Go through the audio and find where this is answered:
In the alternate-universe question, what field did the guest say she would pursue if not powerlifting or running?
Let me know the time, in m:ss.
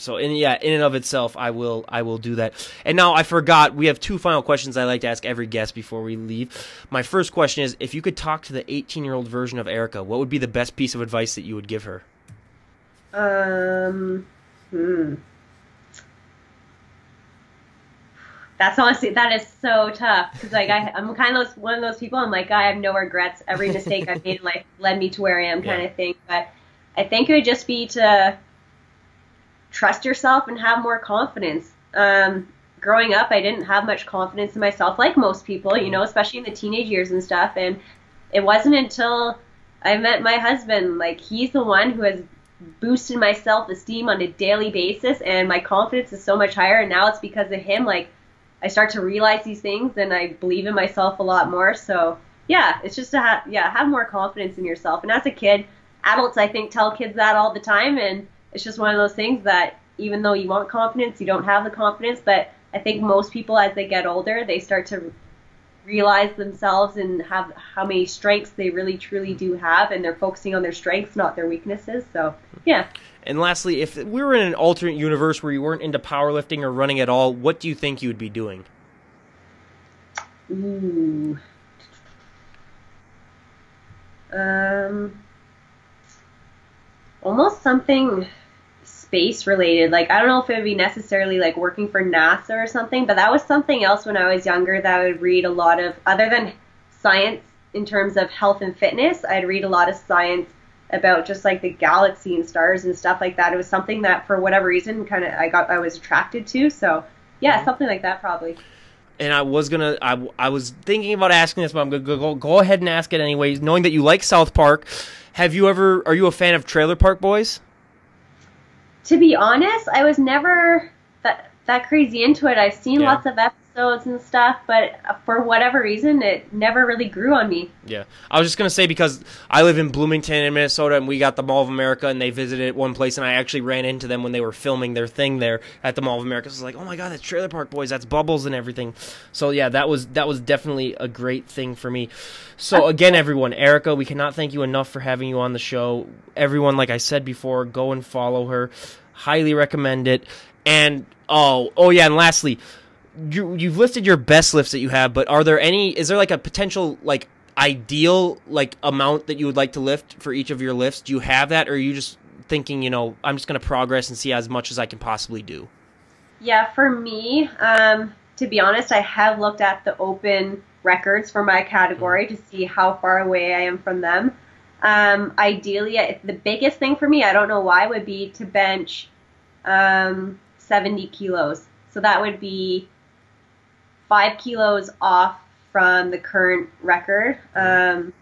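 1:29.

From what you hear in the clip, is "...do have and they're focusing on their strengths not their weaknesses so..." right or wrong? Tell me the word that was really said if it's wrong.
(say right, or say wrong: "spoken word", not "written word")
right.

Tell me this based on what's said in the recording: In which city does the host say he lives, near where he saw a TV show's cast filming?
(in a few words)
Bloomington.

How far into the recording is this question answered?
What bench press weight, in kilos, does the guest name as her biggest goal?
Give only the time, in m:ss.
3:00.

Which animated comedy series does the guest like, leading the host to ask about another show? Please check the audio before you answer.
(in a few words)
South Park.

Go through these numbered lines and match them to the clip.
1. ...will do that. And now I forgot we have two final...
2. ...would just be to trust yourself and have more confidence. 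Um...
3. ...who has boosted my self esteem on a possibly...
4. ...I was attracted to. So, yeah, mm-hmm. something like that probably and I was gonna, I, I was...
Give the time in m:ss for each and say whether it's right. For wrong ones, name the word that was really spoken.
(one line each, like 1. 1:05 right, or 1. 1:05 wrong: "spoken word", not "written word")
1. 0:02 right
2. 0:27 right
3. 0:41 wrong: "daily", not "possibly"
4. 1:45 right.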